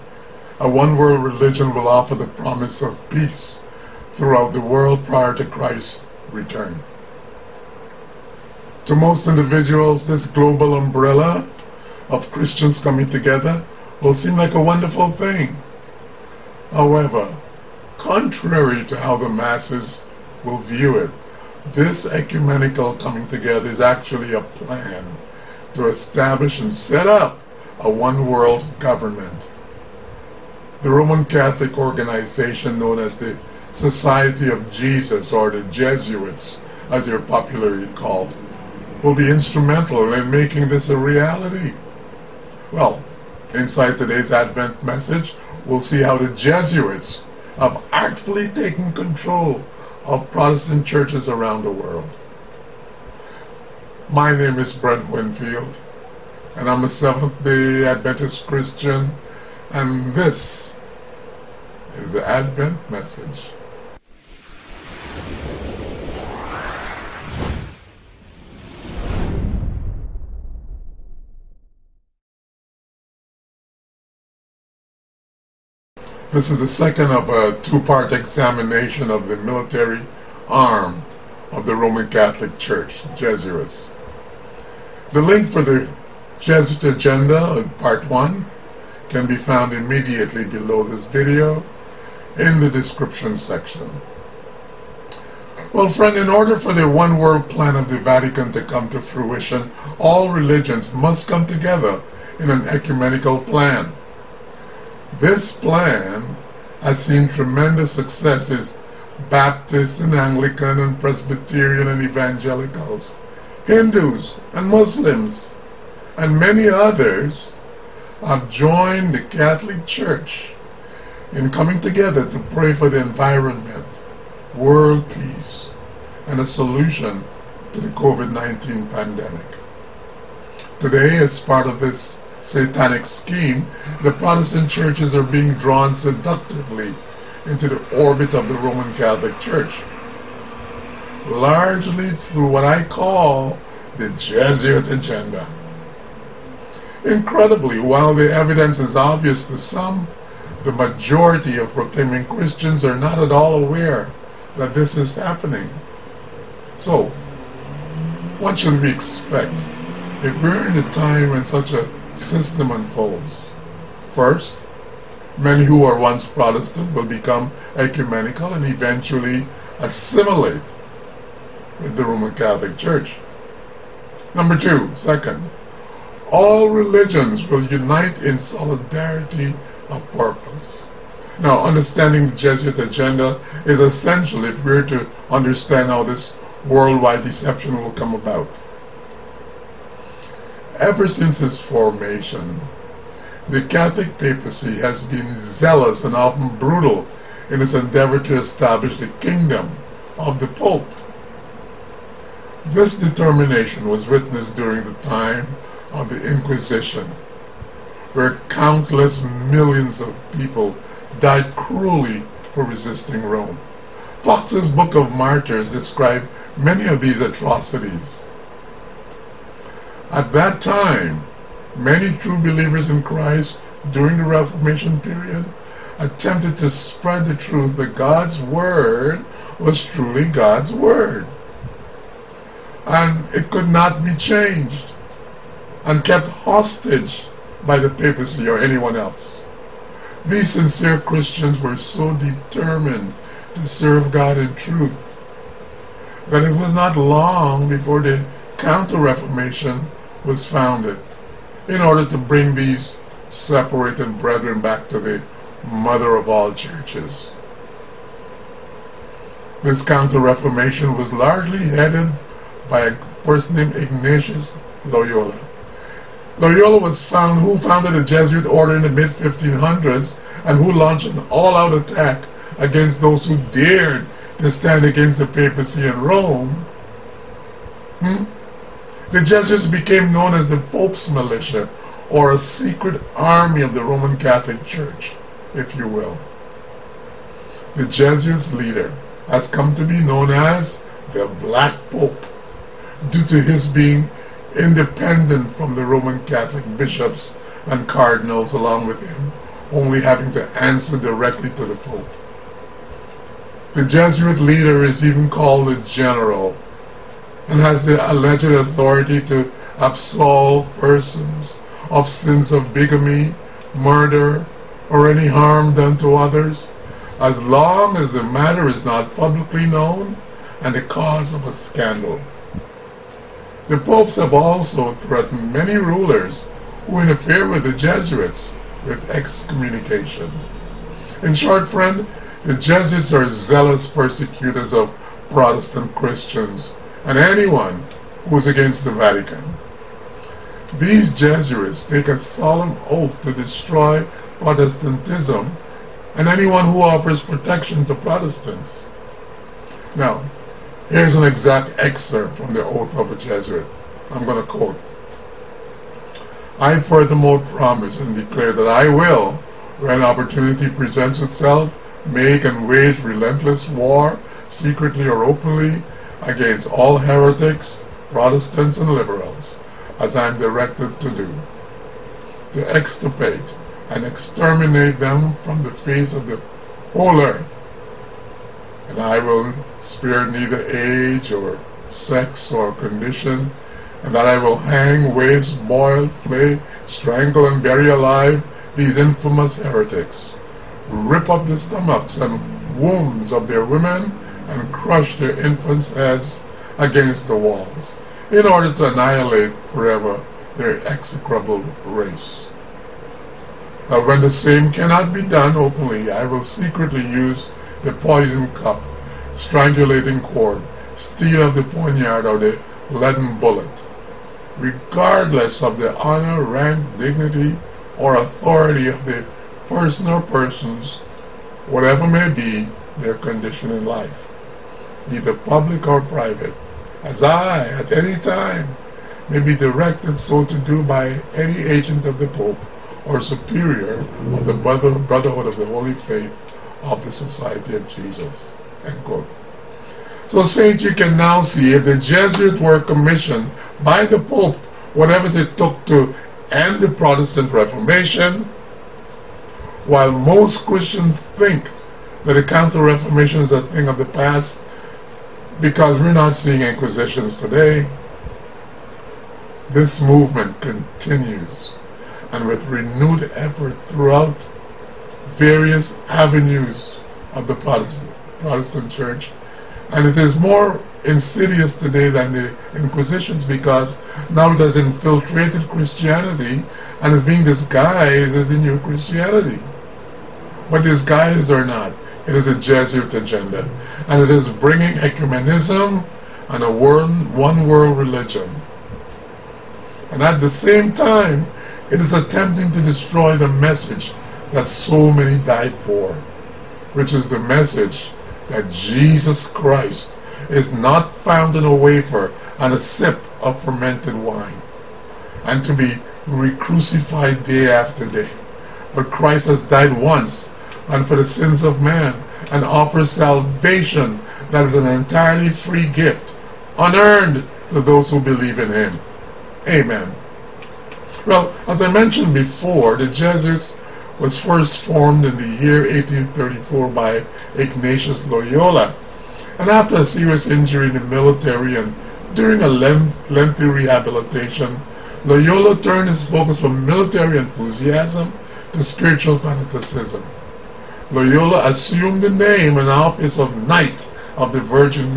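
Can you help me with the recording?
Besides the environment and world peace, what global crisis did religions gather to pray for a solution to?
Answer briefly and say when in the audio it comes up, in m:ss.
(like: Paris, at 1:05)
COVID-19 pandemic, at 2:07.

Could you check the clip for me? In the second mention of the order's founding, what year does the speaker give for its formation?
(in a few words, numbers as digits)
1834.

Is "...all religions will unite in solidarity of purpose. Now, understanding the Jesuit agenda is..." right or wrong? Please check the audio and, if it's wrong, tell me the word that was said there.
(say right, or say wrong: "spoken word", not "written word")
right.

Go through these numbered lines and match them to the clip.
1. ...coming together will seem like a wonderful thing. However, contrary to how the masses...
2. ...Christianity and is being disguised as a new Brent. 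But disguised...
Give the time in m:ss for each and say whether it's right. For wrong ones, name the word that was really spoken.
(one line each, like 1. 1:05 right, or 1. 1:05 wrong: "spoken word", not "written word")
1. 0:12 right
2. 7:55 wrong: "Christianity", not "Brent".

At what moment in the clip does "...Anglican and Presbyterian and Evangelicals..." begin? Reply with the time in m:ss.
1:50.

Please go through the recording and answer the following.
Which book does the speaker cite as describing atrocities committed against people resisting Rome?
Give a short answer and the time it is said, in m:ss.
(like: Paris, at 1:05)
Fox's Book of Martyrs, at 3:34.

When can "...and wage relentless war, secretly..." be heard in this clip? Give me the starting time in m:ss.
6:02.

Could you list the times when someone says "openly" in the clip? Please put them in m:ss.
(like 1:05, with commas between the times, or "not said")
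6:05, 6:45.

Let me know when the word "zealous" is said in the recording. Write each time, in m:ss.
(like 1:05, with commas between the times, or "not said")
3:15, 5:33.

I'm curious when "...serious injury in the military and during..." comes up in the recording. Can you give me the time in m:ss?
8:50.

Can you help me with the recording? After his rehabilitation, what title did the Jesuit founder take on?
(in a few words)
Knight of the Virgin.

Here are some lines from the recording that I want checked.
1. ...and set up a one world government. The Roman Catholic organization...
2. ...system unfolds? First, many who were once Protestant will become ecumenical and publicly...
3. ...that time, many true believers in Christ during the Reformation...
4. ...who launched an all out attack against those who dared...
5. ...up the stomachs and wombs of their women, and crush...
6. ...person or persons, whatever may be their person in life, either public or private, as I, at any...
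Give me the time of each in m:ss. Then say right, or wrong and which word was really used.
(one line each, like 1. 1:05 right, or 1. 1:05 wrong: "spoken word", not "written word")
1. 0:26 right
2. 2:42 wrong: "eventually", not "publicly"
3. 3:40 right
4. 4:30 right
5. 6:31 right
6. 6:59 wrong: "condition", not "person".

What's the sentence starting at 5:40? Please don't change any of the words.
These Jesuits take a solemn oath to destroy Protestantism and anyone who offers protection to Protestants.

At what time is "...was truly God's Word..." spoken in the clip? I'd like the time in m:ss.
3:49.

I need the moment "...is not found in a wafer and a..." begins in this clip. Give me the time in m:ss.
8:20.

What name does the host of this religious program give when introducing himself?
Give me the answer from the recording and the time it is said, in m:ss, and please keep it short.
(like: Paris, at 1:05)
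Brent Winfield, at 0:54.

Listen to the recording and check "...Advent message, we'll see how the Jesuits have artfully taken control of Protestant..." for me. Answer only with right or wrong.
right.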